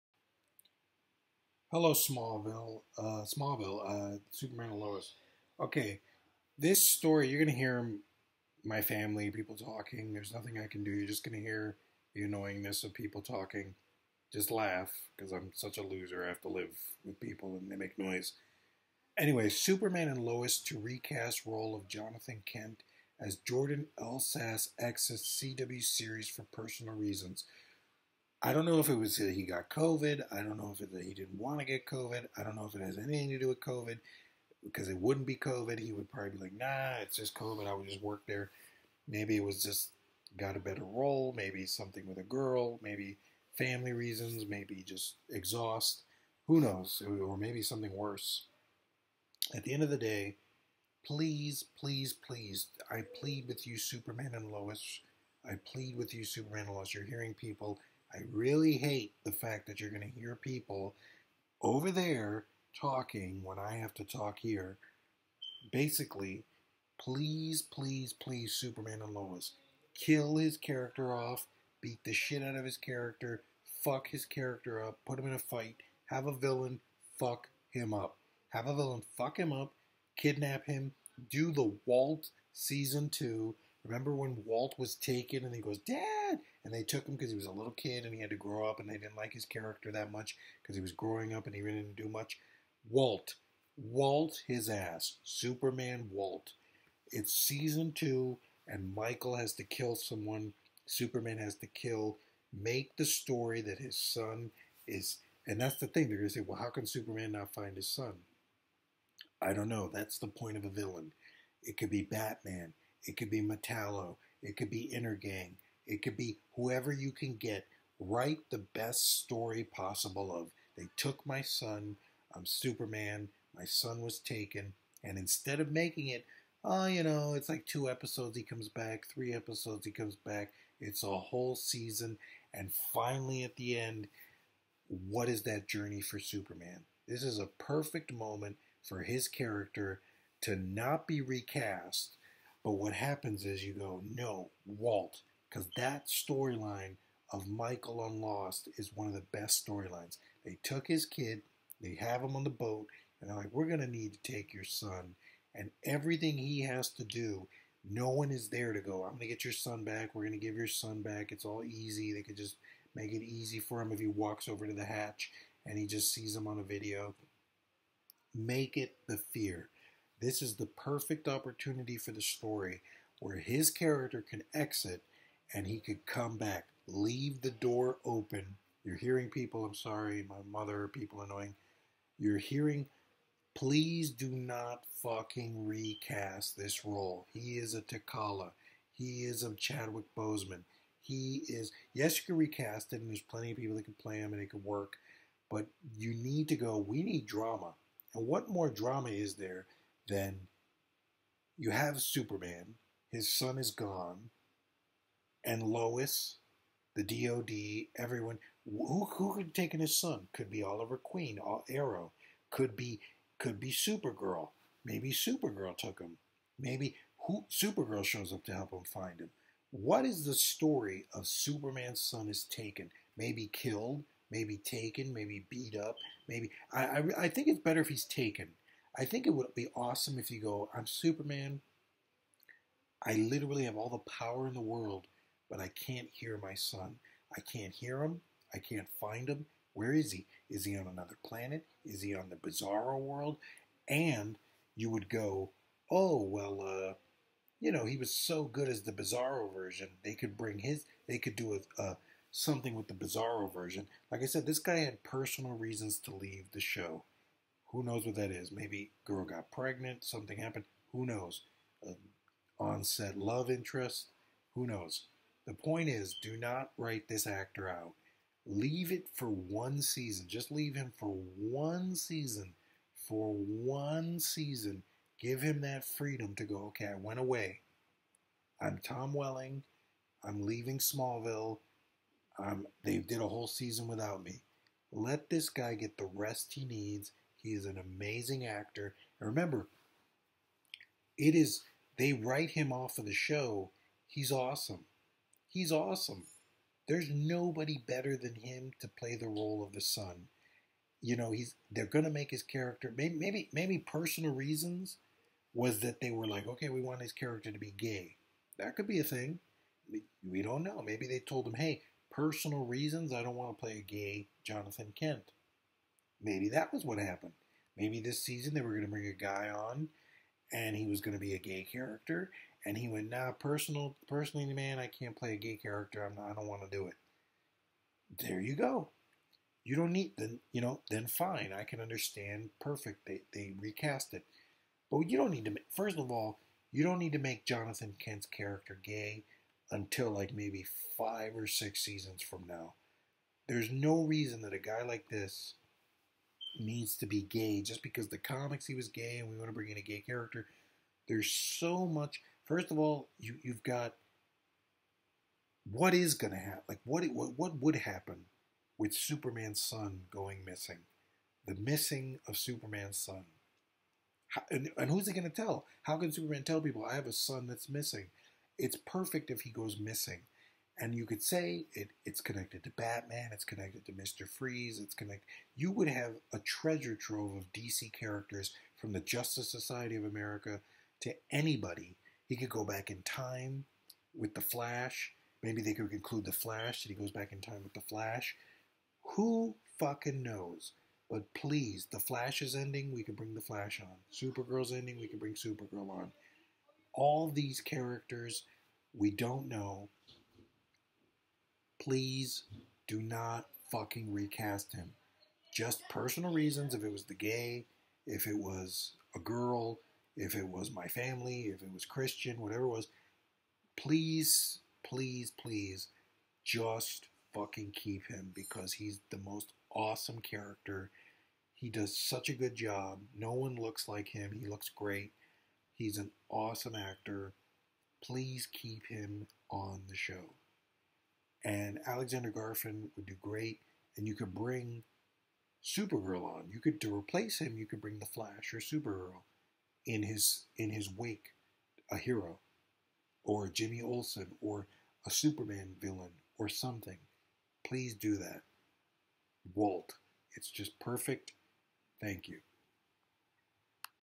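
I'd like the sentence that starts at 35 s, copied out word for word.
He would probably be like, nah, it's just COVID.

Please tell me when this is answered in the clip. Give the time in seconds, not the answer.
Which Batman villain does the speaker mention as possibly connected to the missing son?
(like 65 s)
373 s.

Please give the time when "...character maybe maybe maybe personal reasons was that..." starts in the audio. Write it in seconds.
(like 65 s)
302 s.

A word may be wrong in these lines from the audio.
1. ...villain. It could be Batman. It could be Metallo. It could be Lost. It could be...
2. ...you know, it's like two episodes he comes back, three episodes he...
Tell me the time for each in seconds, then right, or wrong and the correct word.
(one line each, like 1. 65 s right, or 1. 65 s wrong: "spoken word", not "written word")
1. 110 s wrong: "Intergang", not "Lost"
2. 126 s right.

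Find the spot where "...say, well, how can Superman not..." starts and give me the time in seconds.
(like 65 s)
106 s.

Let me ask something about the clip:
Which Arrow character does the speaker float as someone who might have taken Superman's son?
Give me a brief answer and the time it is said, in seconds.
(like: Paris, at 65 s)
Oliver Queen, at 210 s.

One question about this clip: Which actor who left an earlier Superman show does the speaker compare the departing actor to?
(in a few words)
Tom Welling.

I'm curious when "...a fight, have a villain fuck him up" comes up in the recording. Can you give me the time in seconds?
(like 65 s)
75 s.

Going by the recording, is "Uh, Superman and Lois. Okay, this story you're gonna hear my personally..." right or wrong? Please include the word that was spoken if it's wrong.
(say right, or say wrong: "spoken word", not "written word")
wrong: "family", not "personally".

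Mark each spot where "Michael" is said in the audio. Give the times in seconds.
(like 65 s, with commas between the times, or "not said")
98 s, 147 s.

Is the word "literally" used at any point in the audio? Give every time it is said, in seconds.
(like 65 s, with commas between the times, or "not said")
233 s.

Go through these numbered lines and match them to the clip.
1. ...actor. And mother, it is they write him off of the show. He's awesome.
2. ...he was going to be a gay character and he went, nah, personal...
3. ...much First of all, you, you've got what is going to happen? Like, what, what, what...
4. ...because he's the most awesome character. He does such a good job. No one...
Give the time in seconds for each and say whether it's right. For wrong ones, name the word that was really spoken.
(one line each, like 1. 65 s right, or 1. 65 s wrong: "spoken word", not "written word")
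1. 288 s wrong: "remember", not "mother"
2. 320 s right
3. 351 s right
4. 418 s right.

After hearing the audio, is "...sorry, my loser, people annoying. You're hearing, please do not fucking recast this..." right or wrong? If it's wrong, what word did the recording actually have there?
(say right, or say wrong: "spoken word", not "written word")
wrong: "mother", not "loser".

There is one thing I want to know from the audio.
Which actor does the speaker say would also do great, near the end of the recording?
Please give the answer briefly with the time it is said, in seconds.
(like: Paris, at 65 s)
Alexander Garfin, at 431 s.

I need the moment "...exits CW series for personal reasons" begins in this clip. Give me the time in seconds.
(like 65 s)
24 s.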